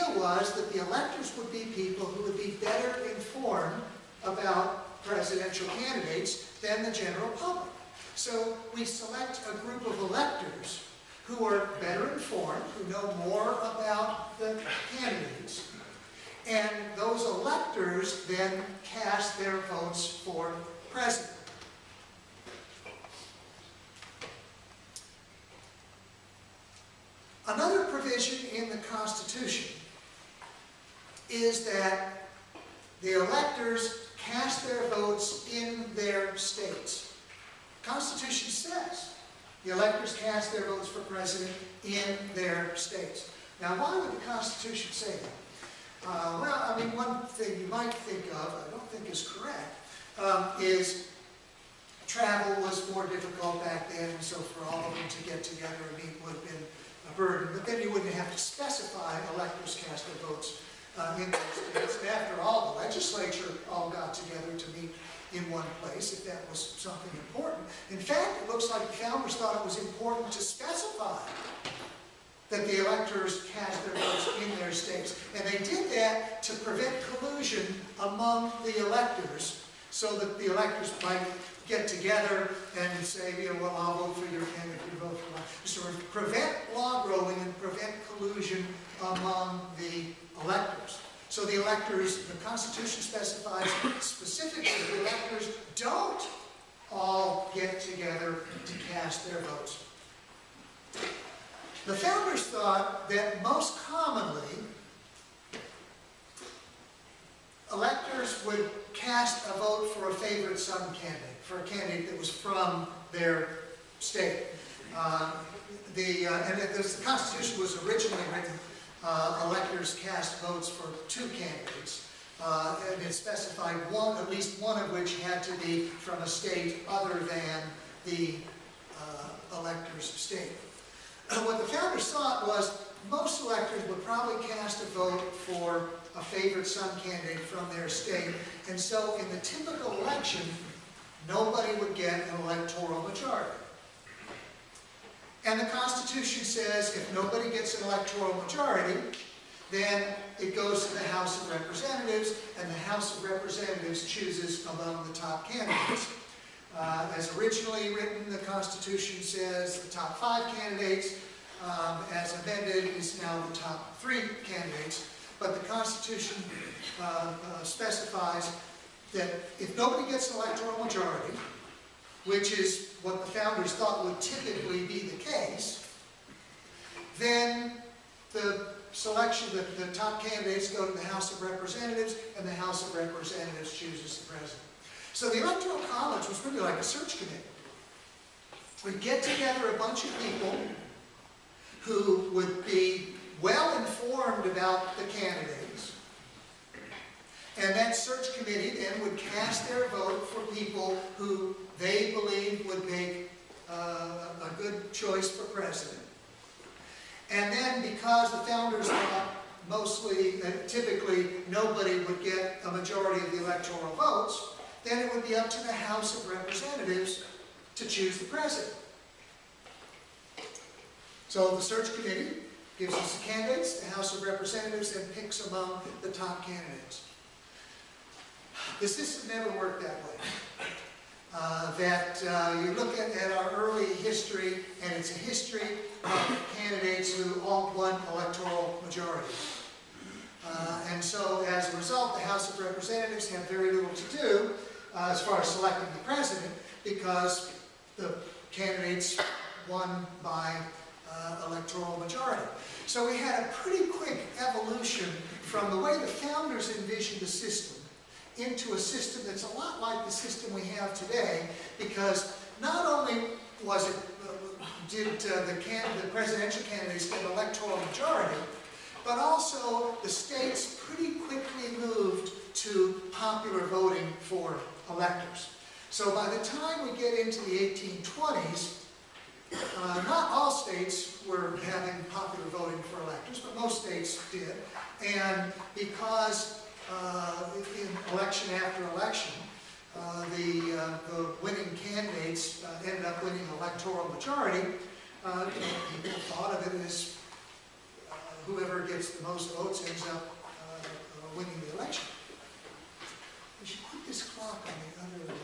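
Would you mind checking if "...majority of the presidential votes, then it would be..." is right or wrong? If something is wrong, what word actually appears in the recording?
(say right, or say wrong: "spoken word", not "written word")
wrong: "electoral", not "presidential".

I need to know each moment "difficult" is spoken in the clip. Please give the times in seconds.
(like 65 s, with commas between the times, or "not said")
53 s.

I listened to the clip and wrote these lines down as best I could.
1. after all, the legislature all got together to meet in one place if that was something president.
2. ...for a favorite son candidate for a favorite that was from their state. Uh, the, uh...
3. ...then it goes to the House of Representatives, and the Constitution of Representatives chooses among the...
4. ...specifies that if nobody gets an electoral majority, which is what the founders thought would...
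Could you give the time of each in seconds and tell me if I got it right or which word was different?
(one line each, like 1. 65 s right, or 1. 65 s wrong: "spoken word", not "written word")
1. 62 s wrong: "important", not "president"
2. 109 s wrong: "candidate", not "favorite"
3. 149 s wrong: "House", not "Constitution"
4. 167 s right.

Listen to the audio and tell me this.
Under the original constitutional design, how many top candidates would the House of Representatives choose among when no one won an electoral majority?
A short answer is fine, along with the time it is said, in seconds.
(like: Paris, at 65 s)
5, at 159 s.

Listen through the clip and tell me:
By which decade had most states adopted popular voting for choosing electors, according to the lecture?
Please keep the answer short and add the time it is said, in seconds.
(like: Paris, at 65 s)
1820s, at 277 s.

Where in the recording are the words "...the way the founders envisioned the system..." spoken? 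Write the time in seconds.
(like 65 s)
255 s.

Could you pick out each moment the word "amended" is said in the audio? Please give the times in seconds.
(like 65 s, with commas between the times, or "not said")
162 s.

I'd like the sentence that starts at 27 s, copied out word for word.
Another provision in the Constitution is that the electors cast their votes in their states.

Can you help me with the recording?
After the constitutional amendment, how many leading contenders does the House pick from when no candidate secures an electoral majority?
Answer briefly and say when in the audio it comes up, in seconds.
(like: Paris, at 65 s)
3, at 163 s.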